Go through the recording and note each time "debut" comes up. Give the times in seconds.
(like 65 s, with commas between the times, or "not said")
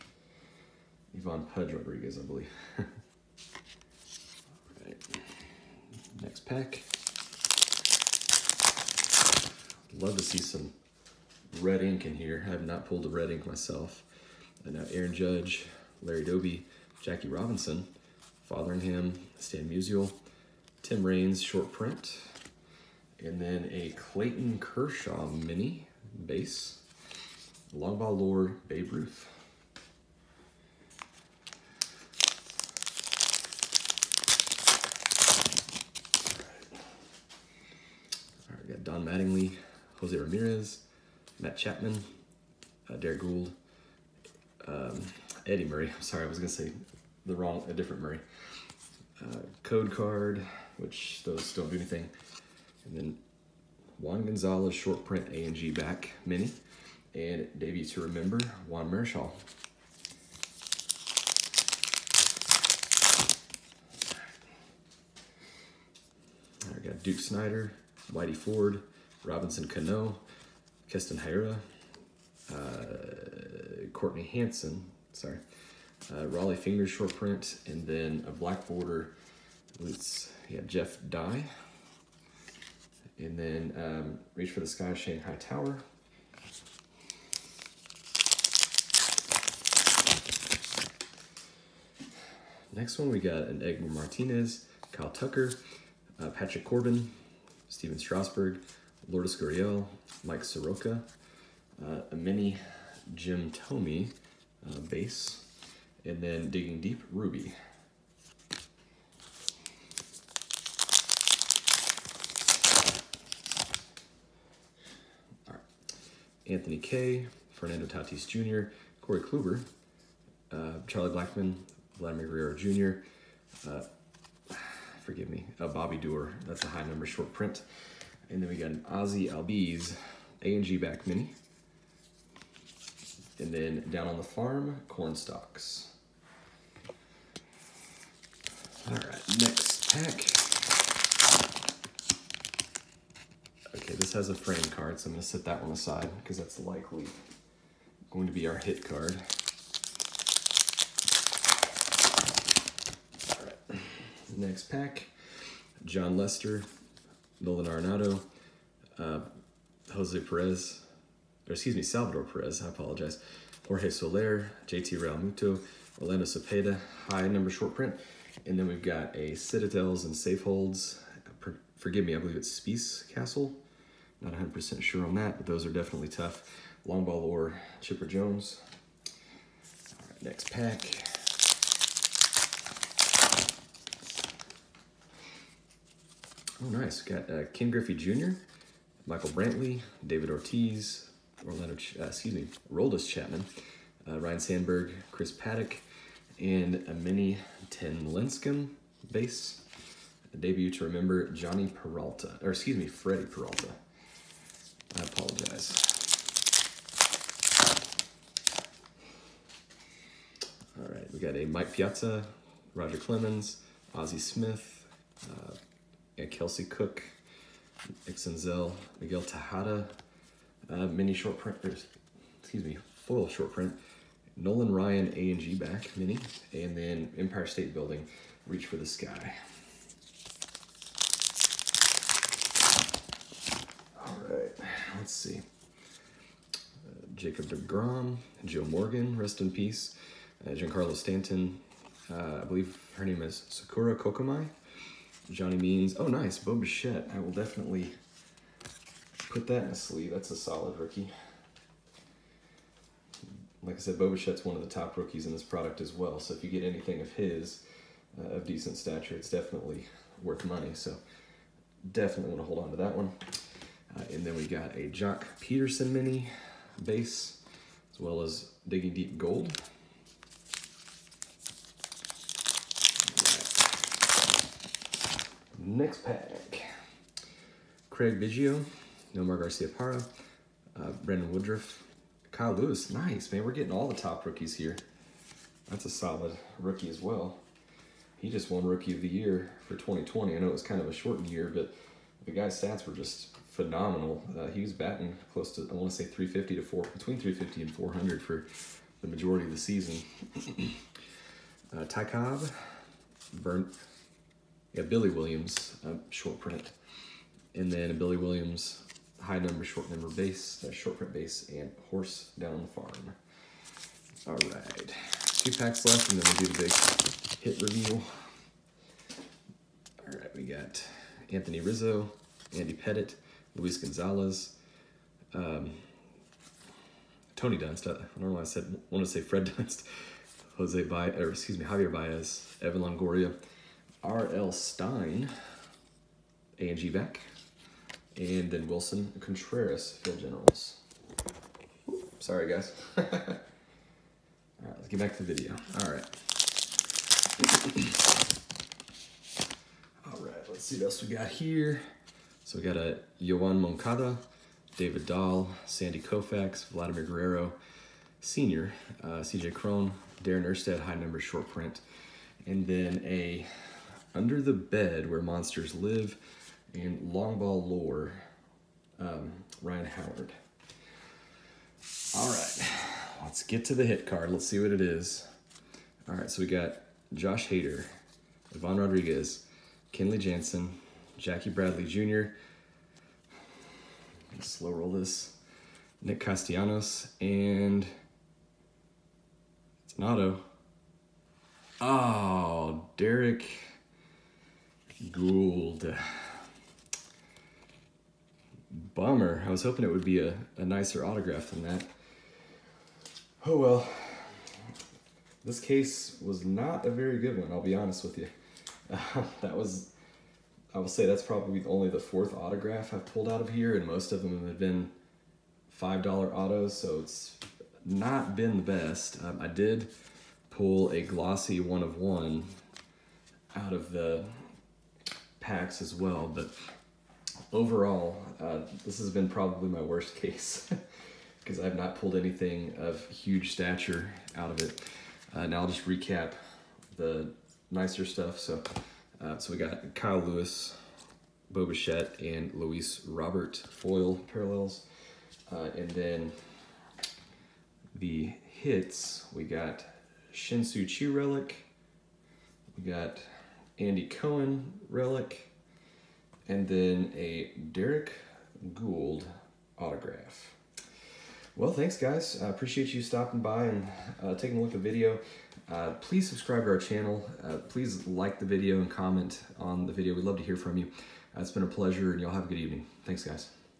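57 s, 200 s.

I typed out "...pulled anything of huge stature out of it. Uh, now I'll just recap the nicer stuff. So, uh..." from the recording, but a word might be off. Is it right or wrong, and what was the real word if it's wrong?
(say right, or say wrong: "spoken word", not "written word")
right.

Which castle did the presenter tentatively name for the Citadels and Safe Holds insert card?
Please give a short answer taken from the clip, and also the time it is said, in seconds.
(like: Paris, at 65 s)
Spies Castle, at 172 s.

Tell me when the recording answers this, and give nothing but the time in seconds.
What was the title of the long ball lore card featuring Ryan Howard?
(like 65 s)
364 s.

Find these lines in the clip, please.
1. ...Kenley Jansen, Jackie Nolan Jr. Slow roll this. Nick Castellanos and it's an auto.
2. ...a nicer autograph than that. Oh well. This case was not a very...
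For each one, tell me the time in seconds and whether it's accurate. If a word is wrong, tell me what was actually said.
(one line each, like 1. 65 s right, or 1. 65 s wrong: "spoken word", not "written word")
1. 379 s wrong: "Bradley", not "Nolan"
2. 400 s right.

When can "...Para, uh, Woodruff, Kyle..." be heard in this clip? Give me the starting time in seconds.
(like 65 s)
279 s.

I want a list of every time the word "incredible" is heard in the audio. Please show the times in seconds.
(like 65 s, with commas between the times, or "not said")
not said.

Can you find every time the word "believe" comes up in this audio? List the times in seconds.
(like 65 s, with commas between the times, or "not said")
2 s, 172 s, 242 s.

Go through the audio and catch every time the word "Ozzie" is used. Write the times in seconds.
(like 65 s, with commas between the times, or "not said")
128 s, 213 s.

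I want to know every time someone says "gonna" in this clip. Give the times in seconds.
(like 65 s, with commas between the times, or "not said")
46 s, 145 s.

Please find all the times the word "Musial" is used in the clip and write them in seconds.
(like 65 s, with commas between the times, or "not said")
19 s.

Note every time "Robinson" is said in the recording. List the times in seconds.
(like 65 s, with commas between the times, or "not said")
17 s, 69 s.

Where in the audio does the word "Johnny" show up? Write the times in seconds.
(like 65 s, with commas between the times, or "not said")
201 s, 245 s.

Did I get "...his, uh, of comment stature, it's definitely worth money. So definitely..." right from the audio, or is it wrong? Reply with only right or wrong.
wrong.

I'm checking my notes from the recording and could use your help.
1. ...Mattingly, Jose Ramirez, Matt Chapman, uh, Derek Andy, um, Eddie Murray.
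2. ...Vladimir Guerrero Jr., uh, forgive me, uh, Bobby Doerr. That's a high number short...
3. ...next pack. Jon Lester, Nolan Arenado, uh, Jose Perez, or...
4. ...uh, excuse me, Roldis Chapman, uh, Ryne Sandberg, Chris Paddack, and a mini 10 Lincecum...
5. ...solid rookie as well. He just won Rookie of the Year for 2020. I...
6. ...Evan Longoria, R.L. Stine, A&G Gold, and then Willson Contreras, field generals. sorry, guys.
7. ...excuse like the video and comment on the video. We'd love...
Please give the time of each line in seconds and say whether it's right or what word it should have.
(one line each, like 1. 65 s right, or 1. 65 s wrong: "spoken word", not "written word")
1. 39 s wrong: "Gould", not "Andy"
2. 121 s right
3. 154 s right
4. 191 s right
5. 285 s right
6. 332 s wrong: "Beck", not "Gold"
7. 467 s wrong: "please", not "excuse".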